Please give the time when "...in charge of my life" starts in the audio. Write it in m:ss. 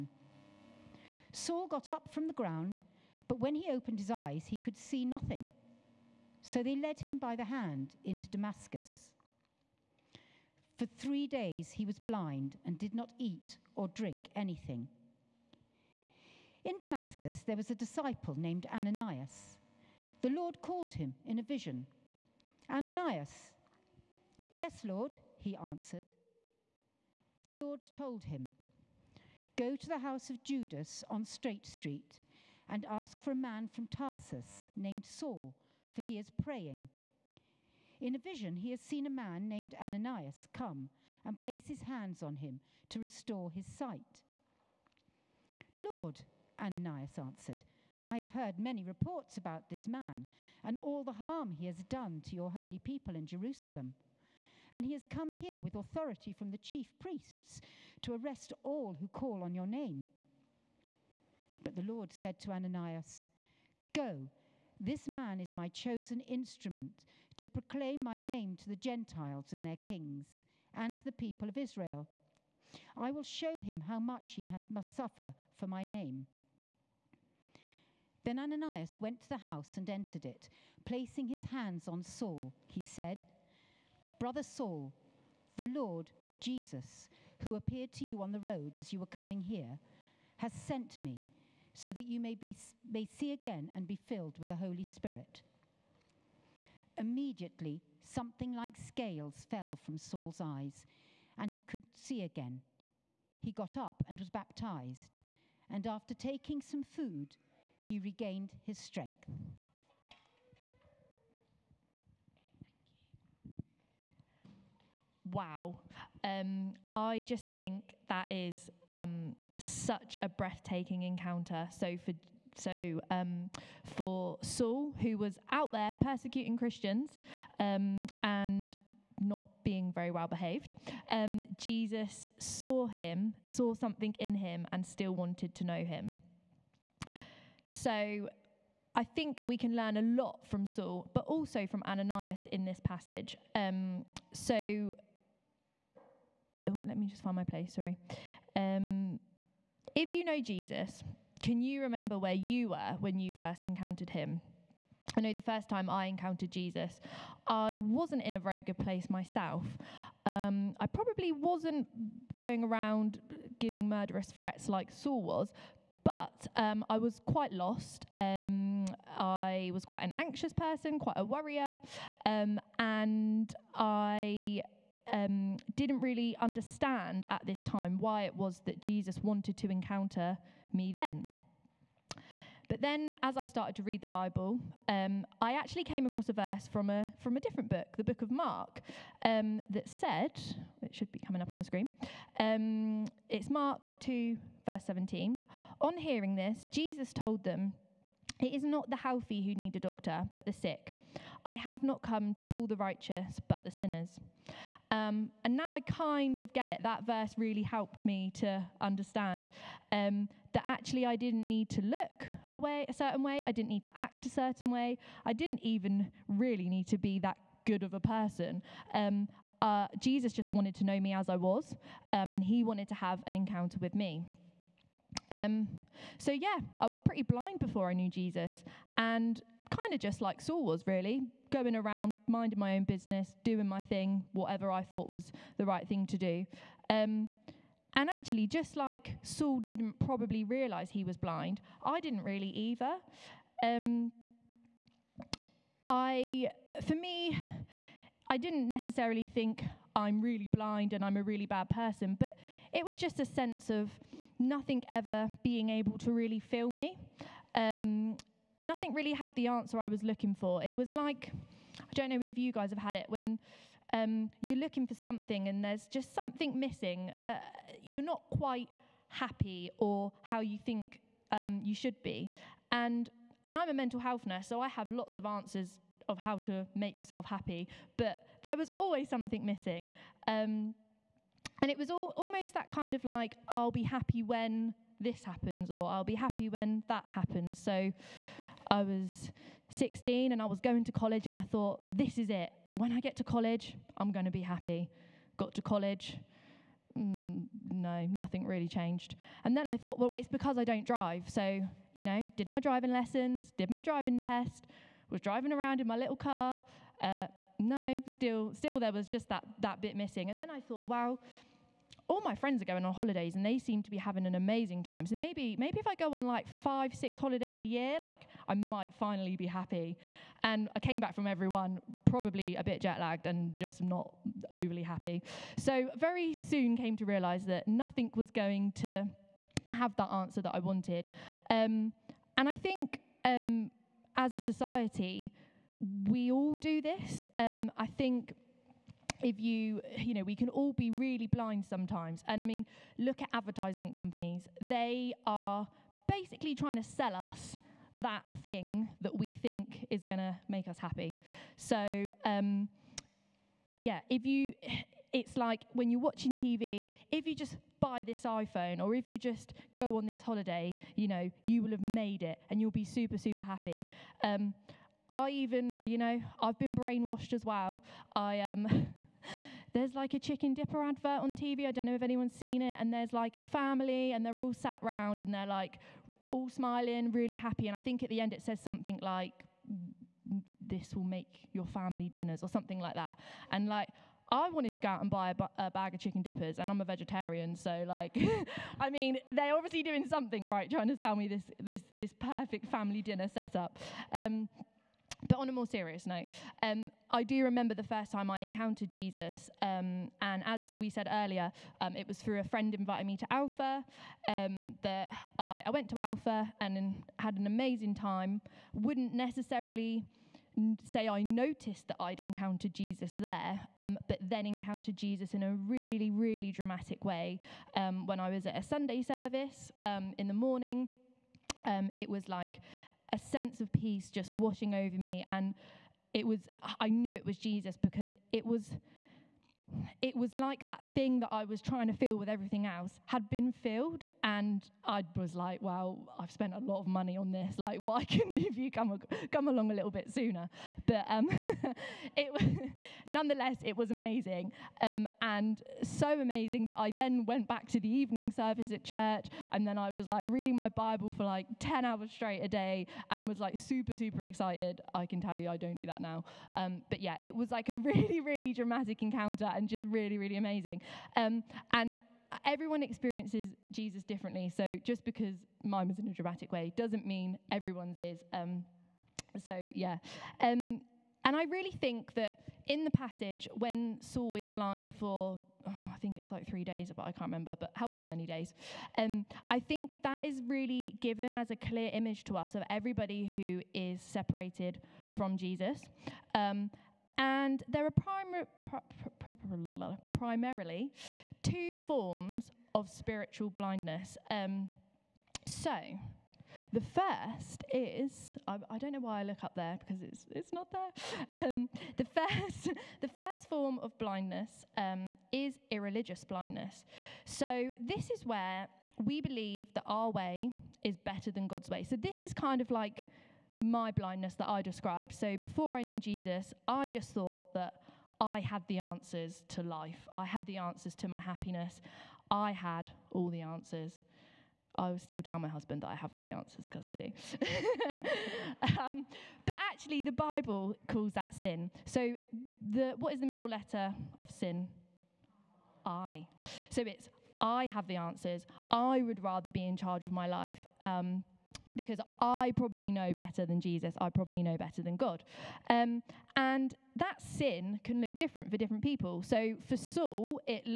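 8:59.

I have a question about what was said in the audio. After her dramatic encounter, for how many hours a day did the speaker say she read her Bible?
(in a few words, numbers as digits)
10.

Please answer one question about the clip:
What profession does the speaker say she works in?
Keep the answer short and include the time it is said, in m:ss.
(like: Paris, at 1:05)
Mental health nurse, at 4:33.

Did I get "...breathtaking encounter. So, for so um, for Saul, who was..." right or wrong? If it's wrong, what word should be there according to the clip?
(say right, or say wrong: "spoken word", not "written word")
right.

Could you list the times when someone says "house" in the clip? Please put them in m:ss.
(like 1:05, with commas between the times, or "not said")
0:29, 1:19.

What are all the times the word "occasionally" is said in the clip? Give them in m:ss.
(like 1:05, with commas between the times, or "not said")
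not said.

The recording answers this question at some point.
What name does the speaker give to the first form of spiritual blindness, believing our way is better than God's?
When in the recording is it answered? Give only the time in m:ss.
8:25.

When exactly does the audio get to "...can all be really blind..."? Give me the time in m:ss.
5:40.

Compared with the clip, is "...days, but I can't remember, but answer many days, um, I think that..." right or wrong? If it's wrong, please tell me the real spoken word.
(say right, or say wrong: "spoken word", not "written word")
wrong: "however", not "answer".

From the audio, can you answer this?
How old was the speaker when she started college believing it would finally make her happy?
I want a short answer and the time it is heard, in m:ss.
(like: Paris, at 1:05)
16, at 4:49.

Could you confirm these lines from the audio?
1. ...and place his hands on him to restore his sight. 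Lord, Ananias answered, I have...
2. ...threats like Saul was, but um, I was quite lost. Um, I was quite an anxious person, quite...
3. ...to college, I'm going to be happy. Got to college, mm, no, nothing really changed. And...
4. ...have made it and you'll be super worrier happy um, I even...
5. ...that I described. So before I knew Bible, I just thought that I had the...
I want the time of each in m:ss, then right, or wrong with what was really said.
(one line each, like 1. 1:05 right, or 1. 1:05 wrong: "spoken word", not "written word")
1. 0:41 right
2. 2:44 right
3. 4:53 right
4. 6:01 wrong: "super", not "worrier"
5. 8:34 wrong: "Jesus", not "Bible".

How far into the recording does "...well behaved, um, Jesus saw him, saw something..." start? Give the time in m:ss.
2:10.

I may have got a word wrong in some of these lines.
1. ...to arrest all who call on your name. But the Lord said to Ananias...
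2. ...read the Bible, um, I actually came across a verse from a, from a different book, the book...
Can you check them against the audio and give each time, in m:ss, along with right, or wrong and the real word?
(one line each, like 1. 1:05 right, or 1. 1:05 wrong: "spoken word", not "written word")
1. 0:58 right
2. 3:03 right.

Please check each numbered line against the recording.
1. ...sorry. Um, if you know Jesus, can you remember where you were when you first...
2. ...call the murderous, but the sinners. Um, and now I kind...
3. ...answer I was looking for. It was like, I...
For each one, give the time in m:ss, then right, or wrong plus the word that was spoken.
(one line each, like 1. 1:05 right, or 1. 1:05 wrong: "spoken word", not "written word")
1. 2:27 right
2. 3:22 wrong: "righteous", not "murderous"
3. 4:19 right.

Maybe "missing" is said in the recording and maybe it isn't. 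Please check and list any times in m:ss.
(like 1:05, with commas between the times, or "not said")
4:26, 4:39, 5:09.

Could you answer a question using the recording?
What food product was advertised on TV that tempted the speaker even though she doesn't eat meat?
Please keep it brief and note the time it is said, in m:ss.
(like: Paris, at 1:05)
Chicken dippers, at 6:10.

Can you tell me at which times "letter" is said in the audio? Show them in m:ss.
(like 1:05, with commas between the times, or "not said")
8:53.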